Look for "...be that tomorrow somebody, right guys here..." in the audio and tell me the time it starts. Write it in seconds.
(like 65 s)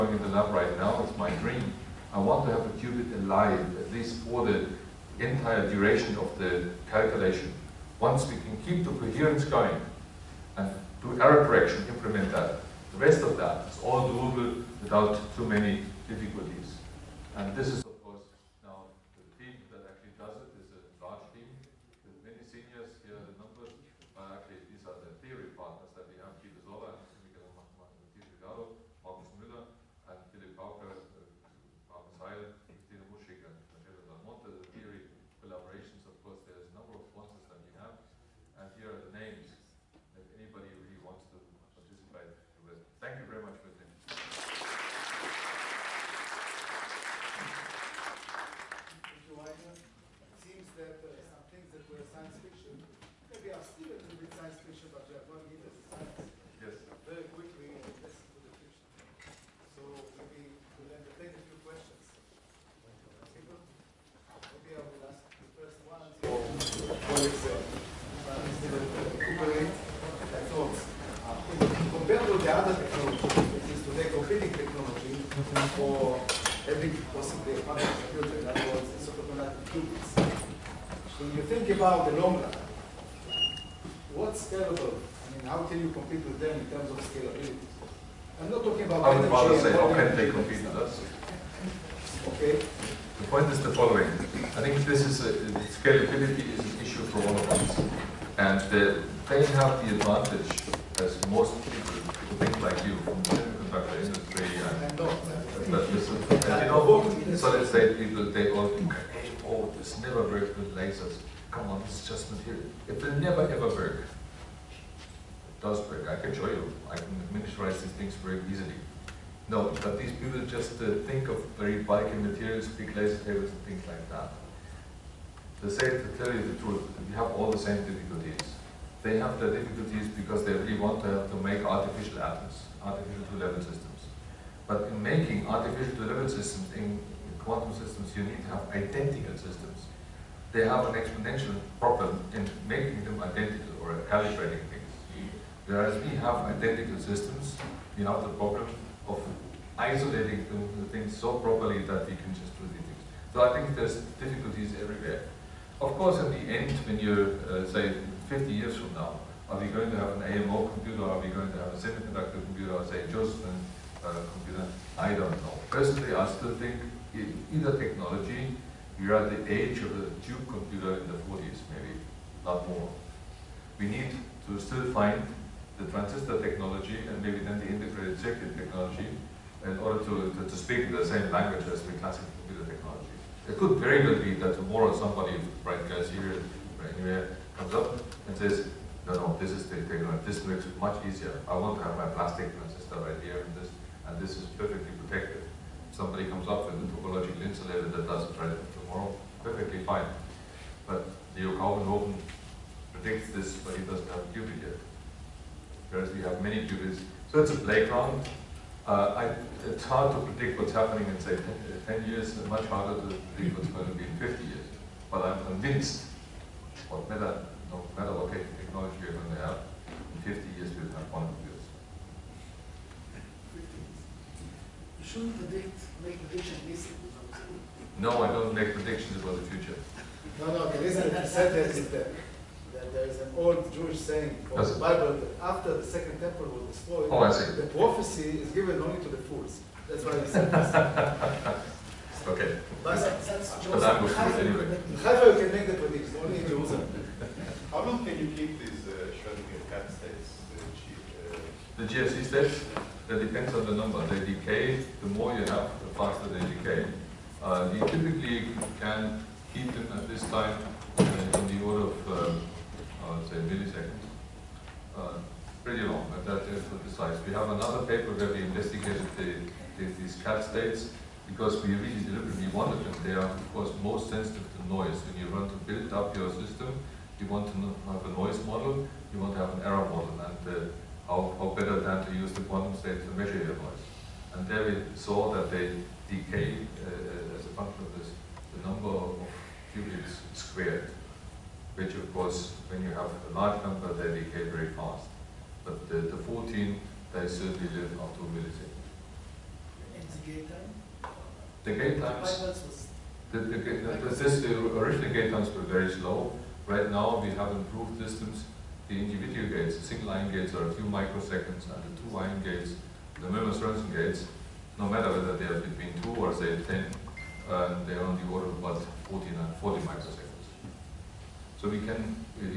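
184 s.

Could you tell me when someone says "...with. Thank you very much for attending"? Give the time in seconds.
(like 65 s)
42 s.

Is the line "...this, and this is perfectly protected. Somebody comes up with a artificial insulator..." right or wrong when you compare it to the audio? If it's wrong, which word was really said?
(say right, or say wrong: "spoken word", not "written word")
wrong: "topological", not "artificial".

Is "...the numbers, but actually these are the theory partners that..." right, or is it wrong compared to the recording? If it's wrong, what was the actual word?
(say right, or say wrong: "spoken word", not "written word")
right.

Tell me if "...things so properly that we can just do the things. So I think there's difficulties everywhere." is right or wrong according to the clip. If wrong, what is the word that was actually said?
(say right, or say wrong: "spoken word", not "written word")
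right.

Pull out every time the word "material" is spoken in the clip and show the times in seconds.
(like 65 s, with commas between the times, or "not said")
112 s, 122 s.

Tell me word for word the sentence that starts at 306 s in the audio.
Right now we have improved systems.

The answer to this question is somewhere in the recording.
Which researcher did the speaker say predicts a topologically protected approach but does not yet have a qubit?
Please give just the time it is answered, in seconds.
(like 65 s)
201 s.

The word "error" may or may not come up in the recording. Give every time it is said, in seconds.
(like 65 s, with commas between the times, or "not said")
11 s, 279 s.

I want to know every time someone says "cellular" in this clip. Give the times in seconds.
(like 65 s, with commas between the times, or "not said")
not said.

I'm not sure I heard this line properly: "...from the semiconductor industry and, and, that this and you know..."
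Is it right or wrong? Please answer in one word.
right.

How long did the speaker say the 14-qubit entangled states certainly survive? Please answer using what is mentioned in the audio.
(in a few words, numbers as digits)
Up to a millisecond.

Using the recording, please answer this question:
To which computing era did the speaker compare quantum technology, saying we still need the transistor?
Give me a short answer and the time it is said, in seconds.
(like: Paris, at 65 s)
Tube computer in the 40s, at 169 s.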